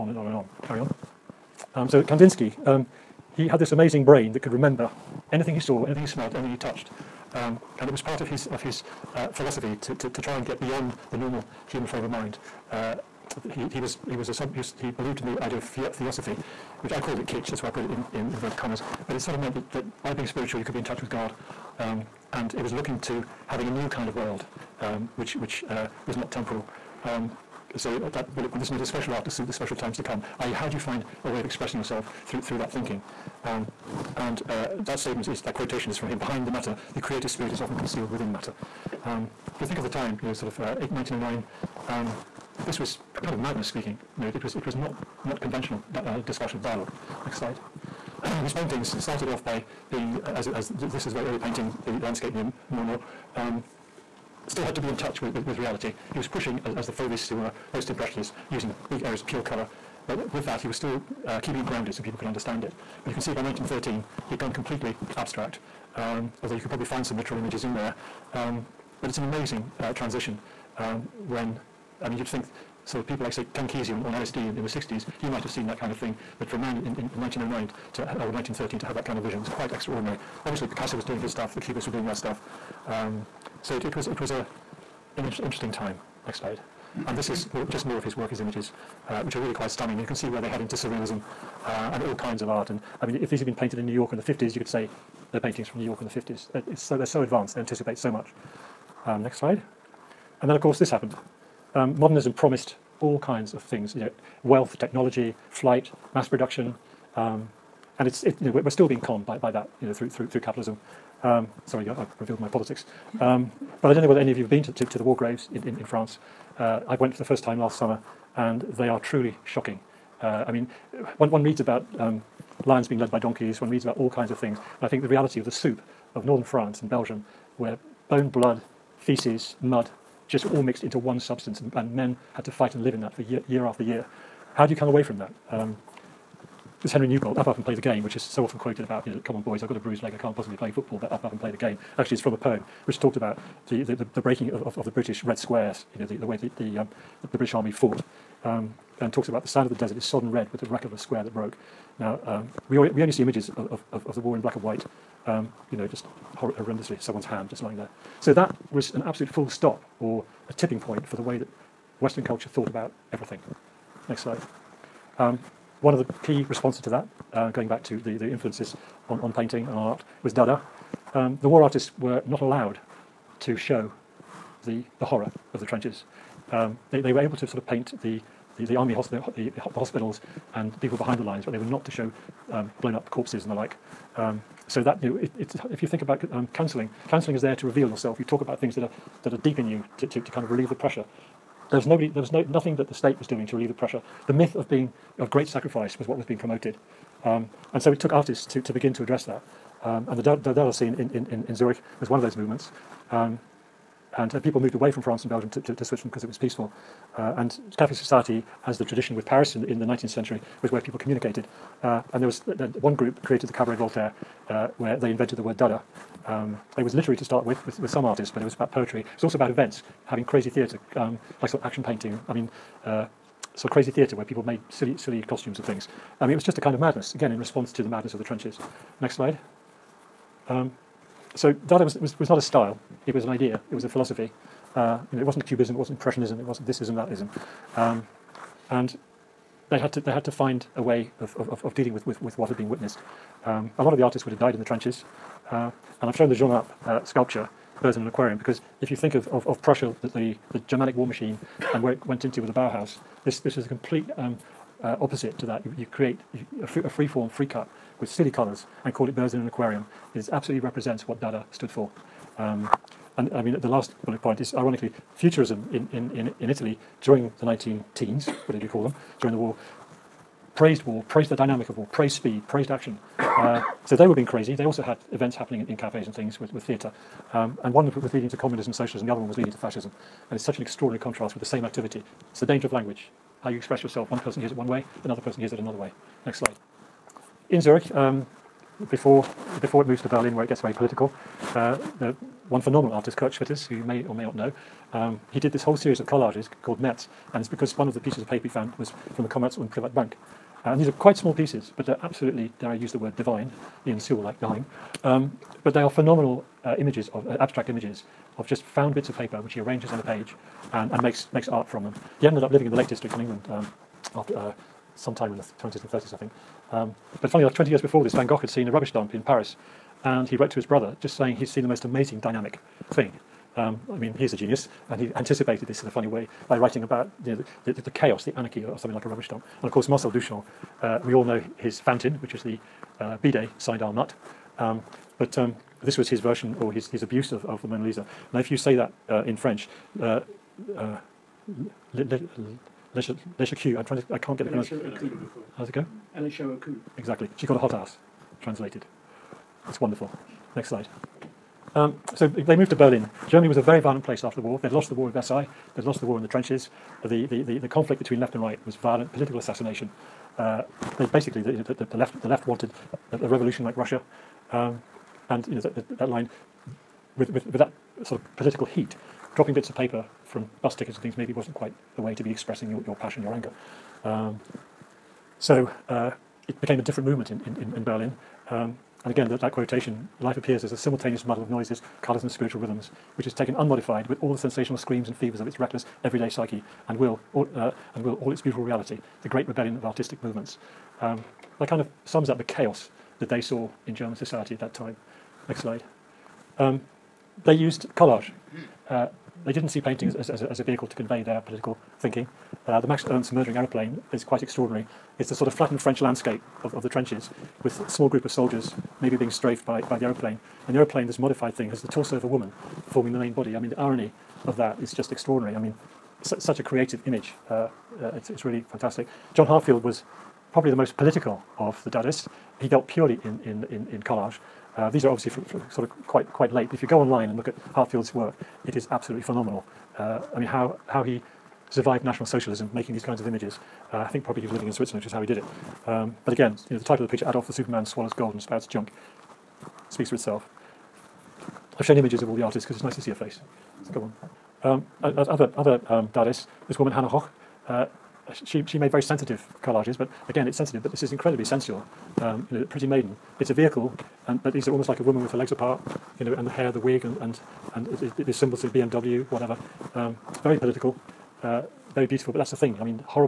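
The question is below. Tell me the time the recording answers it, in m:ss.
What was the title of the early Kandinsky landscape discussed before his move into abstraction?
0:51.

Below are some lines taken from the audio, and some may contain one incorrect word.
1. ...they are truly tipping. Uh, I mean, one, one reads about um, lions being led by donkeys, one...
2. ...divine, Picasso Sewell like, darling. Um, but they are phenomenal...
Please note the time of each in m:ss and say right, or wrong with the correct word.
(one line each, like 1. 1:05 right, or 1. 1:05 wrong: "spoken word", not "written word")
1. 1:58 wrong: "shocking", not "tipping"
2. 5:03 wrong: "Brian", not "Picasso".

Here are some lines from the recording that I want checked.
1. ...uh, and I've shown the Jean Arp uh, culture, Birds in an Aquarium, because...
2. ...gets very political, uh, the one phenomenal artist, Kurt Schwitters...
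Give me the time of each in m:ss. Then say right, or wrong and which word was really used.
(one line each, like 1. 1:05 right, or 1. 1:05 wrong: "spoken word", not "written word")
1. 4:05 wrong: "sculpture", not "culture"
2. 4:50 right.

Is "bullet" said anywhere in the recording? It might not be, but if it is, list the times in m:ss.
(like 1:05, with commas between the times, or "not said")
0:28, 4:24.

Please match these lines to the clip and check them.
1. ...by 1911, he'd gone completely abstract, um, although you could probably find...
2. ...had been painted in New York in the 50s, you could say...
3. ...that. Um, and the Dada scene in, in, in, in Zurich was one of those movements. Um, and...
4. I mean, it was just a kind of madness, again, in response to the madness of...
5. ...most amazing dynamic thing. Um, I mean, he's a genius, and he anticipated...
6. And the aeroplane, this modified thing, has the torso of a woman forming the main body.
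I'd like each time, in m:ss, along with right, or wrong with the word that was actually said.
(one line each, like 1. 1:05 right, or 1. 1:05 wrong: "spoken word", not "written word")
1. 1:03 wrong: "1913", not "1911"
2. 1:33 right
3. 3:19 right
4. 3:46 right
5. 5:21 right
6. 6:50 right.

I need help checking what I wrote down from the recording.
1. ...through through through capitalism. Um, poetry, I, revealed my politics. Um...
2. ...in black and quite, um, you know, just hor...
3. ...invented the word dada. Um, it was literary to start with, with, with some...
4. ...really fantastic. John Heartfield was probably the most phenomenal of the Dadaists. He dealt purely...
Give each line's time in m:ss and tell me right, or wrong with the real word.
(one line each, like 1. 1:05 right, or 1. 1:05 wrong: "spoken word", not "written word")
1. 1:49 wrong: "sorry", not "poetry"
2. 2:34 wrong: "white", not "quite"
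3. 3:35 right
4. 6:58 wrong: "political", not "phenomenal".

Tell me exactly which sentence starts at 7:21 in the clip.
I've shown images of all the artists because it's nice to see a face.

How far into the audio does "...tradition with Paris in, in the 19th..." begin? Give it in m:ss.
3:28.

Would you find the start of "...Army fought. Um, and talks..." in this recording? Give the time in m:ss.
2:27.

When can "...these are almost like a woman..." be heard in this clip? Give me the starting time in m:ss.
7:34.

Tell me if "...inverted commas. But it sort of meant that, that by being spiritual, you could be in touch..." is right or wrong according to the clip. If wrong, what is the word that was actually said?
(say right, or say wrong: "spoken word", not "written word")
right.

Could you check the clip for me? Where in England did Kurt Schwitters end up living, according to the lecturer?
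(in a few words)
The Lake District.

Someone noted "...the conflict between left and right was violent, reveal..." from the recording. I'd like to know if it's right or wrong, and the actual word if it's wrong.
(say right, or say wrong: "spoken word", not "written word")
wrong: "political", not "reveal".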